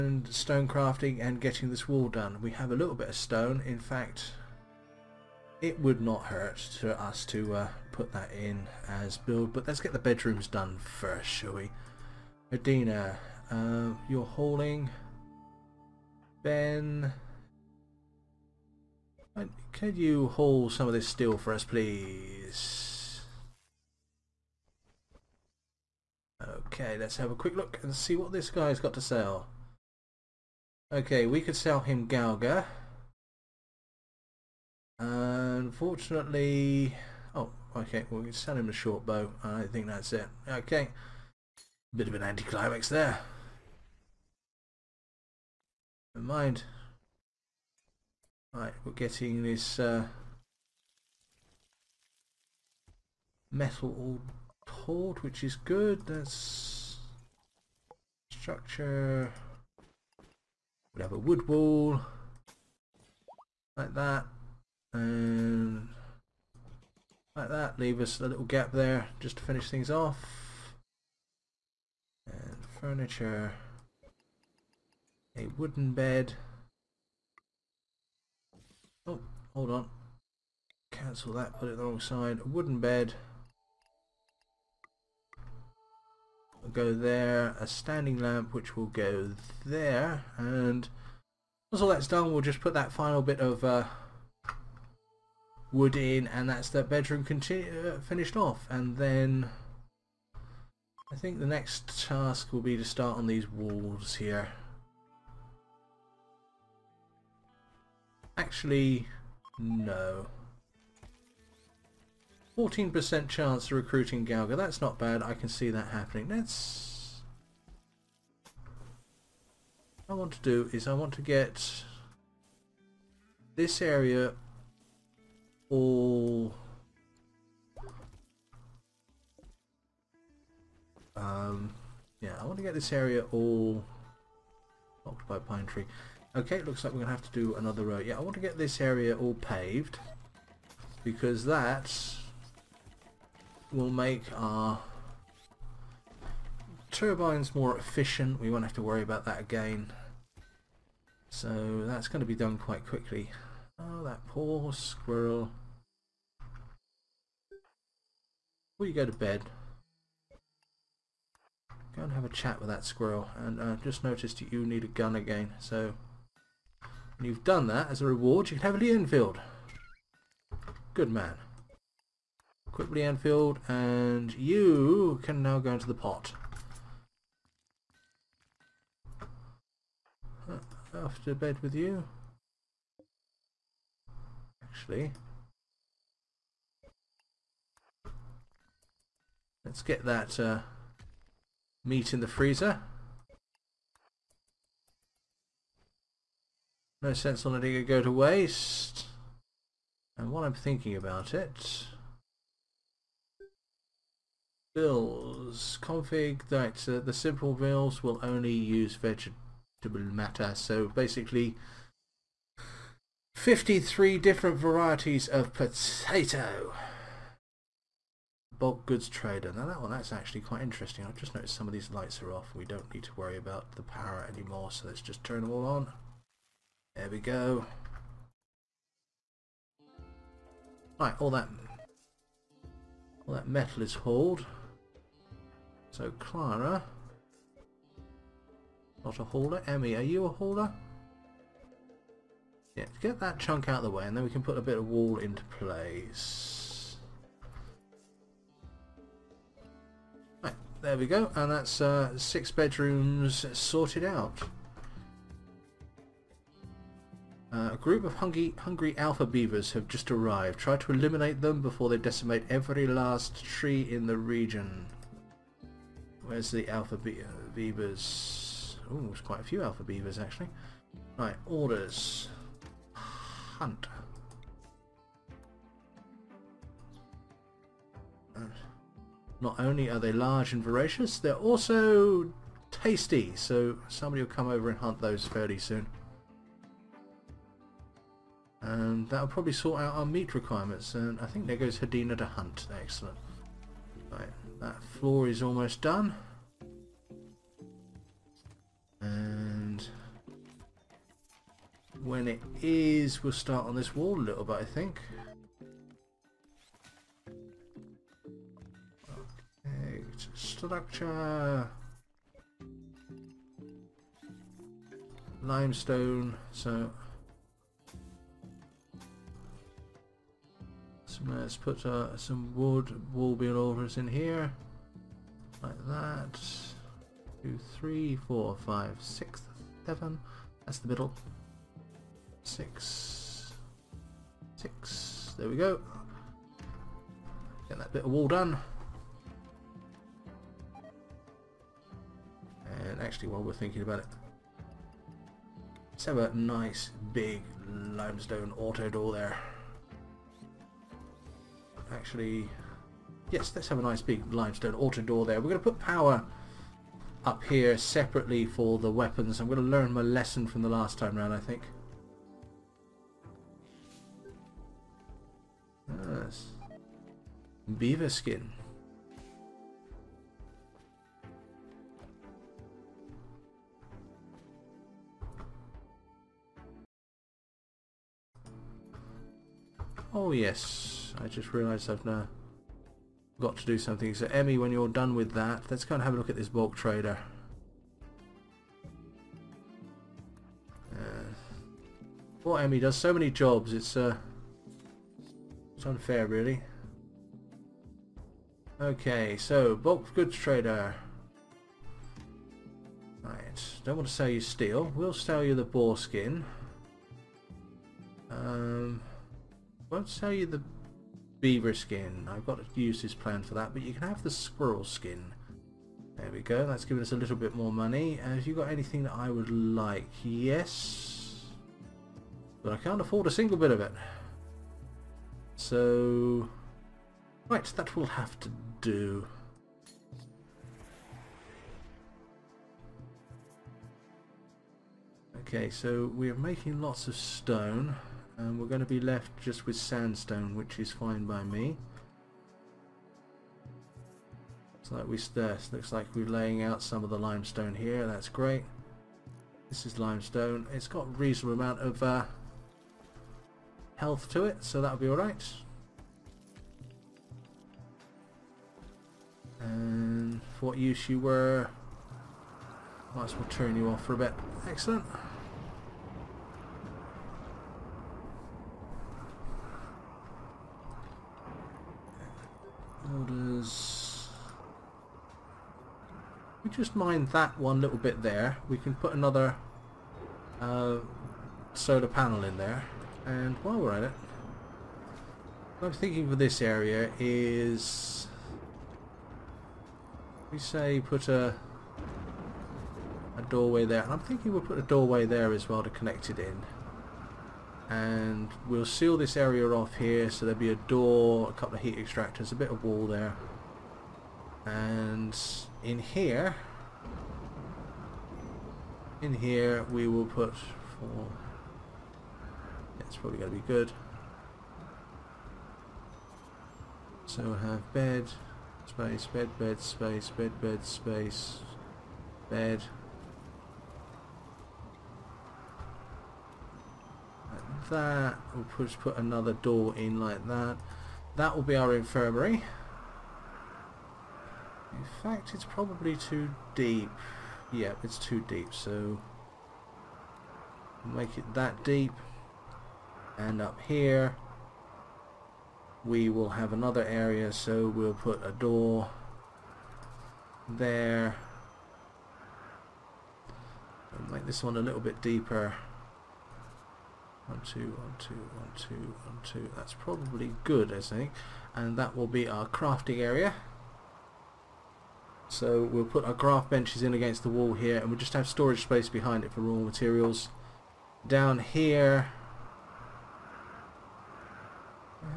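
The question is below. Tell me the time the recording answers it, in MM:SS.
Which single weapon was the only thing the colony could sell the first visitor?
00:38.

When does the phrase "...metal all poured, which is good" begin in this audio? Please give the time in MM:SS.
00:53.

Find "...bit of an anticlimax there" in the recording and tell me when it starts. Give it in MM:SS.
00:41.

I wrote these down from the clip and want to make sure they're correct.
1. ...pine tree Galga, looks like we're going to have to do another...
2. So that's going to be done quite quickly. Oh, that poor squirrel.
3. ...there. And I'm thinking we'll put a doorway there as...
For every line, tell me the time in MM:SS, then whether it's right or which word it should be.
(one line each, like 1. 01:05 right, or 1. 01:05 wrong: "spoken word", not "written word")
1. 02:15 wrong: "Okay", not "Galga"
2. 02:31 right
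3. 08:13 right.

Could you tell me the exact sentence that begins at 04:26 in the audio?
Where's the alpha be uh, beavers?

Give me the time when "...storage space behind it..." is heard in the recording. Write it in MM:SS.
09:28.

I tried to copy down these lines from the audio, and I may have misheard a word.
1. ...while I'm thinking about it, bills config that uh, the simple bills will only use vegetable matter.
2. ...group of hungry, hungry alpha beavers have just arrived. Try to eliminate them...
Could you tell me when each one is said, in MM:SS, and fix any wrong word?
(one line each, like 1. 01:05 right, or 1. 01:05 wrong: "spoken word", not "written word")
1. 03:20 right
2. 04:17 right.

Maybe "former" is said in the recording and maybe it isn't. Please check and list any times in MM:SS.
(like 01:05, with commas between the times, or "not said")
not said.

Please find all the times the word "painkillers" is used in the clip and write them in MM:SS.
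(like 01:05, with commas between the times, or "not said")
not said.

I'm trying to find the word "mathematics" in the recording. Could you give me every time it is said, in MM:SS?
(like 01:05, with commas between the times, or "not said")
not said.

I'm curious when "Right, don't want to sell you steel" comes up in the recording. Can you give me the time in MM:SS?
06:43.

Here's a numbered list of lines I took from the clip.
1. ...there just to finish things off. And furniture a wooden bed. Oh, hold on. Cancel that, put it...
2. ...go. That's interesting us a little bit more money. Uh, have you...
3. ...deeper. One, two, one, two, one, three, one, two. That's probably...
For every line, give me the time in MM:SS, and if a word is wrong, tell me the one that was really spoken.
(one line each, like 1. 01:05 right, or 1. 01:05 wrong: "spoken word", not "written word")
1. 01:08 right
2. 06:56 wrong: "giving", not "interesting"
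3. 09:15 wrong: "two", not "three".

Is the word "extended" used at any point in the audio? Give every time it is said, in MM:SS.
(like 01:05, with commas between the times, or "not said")
not said.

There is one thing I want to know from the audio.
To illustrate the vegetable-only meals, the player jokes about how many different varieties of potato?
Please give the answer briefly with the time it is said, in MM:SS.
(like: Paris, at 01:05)
53, at 03:33.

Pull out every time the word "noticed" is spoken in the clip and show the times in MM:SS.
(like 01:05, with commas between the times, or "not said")
02:44, 03:41.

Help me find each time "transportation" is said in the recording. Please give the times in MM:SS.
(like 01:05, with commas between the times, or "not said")
not said.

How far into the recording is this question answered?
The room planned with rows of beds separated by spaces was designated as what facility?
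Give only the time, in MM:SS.
08:51.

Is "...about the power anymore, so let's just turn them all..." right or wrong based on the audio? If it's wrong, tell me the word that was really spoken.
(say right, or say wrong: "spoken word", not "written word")
right.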